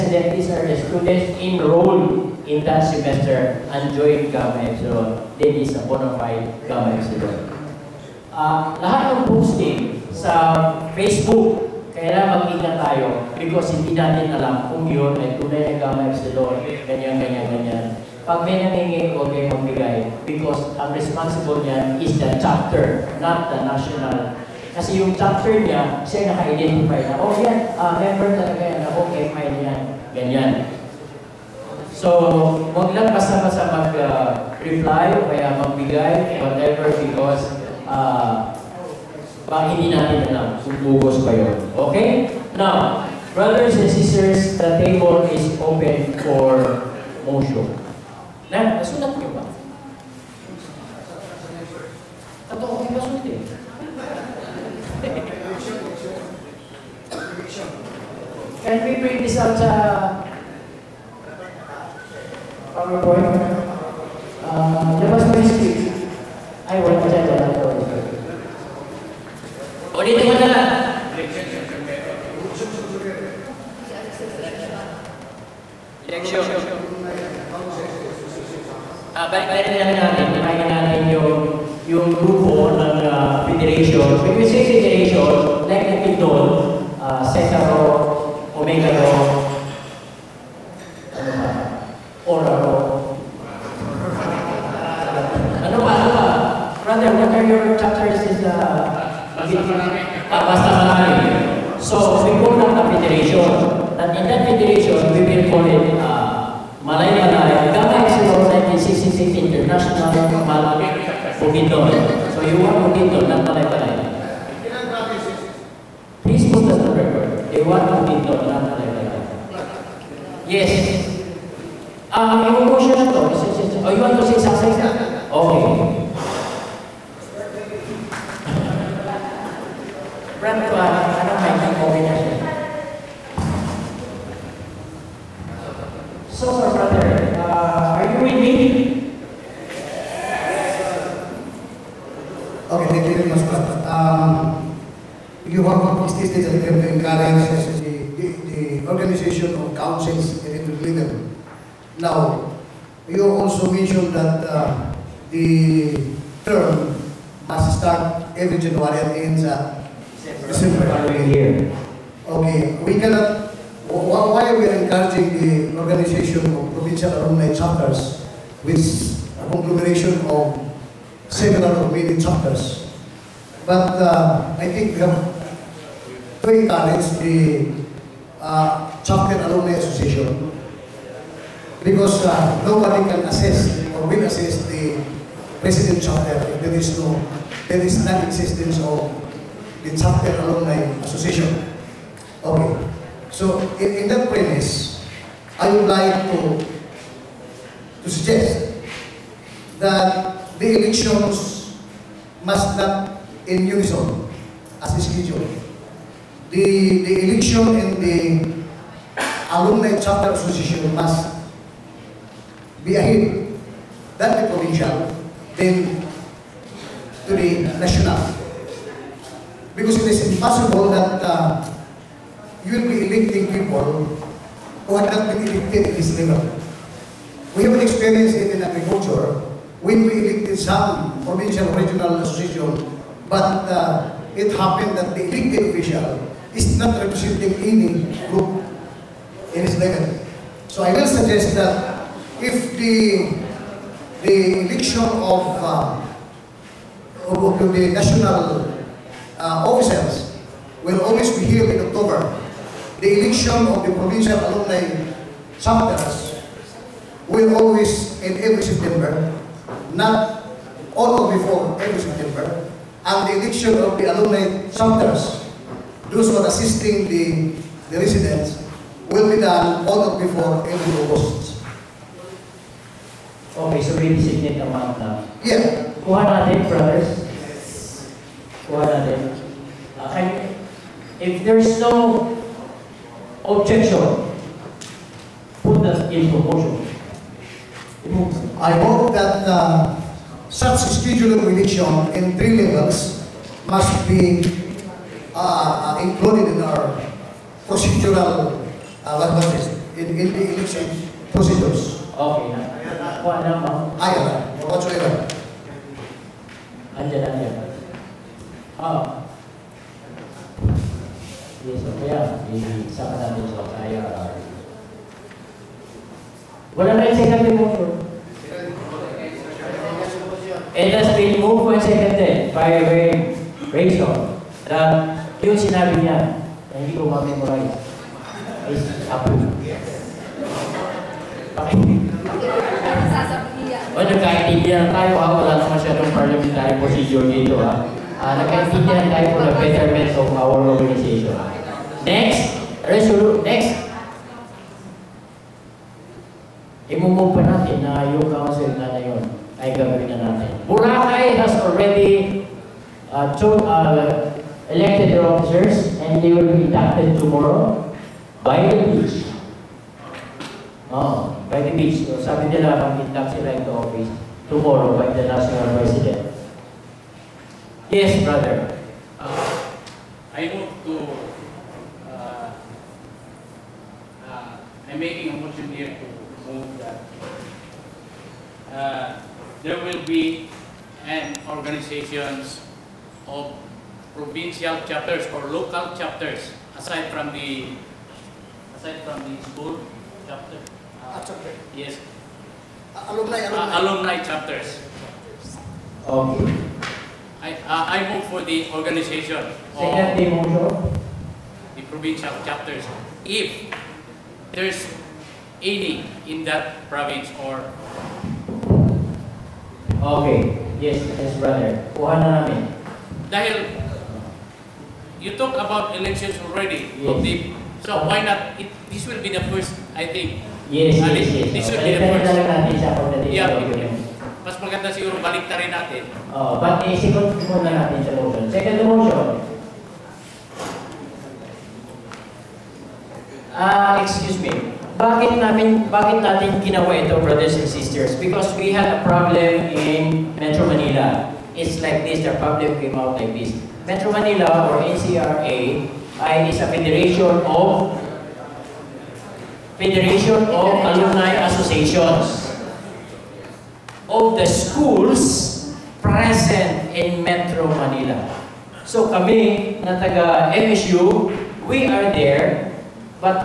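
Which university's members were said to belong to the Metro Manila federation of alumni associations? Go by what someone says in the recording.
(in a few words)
MSU.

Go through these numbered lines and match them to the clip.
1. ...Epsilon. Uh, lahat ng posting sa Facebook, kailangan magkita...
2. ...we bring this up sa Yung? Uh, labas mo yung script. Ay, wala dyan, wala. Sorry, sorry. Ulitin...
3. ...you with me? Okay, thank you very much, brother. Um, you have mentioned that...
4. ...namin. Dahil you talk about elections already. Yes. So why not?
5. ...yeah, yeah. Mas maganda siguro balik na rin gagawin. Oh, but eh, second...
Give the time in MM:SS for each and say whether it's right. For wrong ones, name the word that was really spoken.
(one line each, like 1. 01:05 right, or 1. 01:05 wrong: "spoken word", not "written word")
1. 00:06 right
2. 00:58 wrong: "PowerPoint", not "Yung"
3. 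02:18 wrong: "stated", not "mentioned"
4. 06:52 right
5. 07:03 wrong: "natin", not "gagawin".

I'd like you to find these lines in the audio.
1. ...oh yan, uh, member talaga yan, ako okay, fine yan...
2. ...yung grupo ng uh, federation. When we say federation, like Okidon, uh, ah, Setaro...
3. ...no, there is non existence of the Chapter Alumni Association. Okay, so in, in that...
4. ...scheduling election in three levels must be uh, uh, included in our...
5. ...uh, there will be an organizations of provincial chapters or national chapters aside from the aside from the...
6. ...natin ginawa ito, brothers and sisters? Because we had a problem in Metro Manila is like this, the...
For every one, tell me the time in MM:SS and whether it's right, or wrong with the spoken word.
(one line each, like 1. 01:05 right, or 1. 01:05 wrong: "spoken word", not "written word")
1. 00:27 right
2. 01:21 right
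3. 03:06 right
4. 04:51 right
5. 06:18 wrong: "local", not "national"
6. 07:16 right.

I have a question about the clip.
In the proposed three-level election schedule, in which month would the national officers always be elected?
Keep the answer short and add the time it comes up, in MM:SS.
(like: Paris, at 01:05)
October, at 04:11.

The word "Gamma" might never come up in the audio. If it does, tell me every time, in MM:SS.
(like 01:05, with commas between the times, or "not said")
00:15, 01:47.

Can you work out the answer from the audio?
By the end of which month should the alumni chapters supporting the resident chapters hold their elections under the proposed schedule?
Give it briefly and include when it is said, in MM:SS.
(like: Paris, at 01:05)
August, at 04:30.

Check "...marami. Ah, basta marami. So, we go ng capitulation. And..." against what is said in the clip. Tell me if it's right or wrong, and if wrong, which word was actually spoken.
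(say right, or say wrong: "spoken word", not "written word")
right.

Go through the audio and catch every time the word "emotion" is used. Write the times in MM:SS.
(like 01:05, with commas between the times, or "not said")
02:02.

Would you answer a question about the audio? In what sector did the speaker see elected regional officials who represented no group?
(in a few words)
agriculture.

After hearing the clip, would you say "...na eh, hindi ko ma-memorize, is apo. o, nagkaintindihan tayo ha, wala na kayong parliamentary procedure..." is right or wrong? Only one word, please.
wrong.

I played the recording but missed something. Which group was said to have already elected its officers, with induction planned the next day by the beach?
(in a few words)
Boracay.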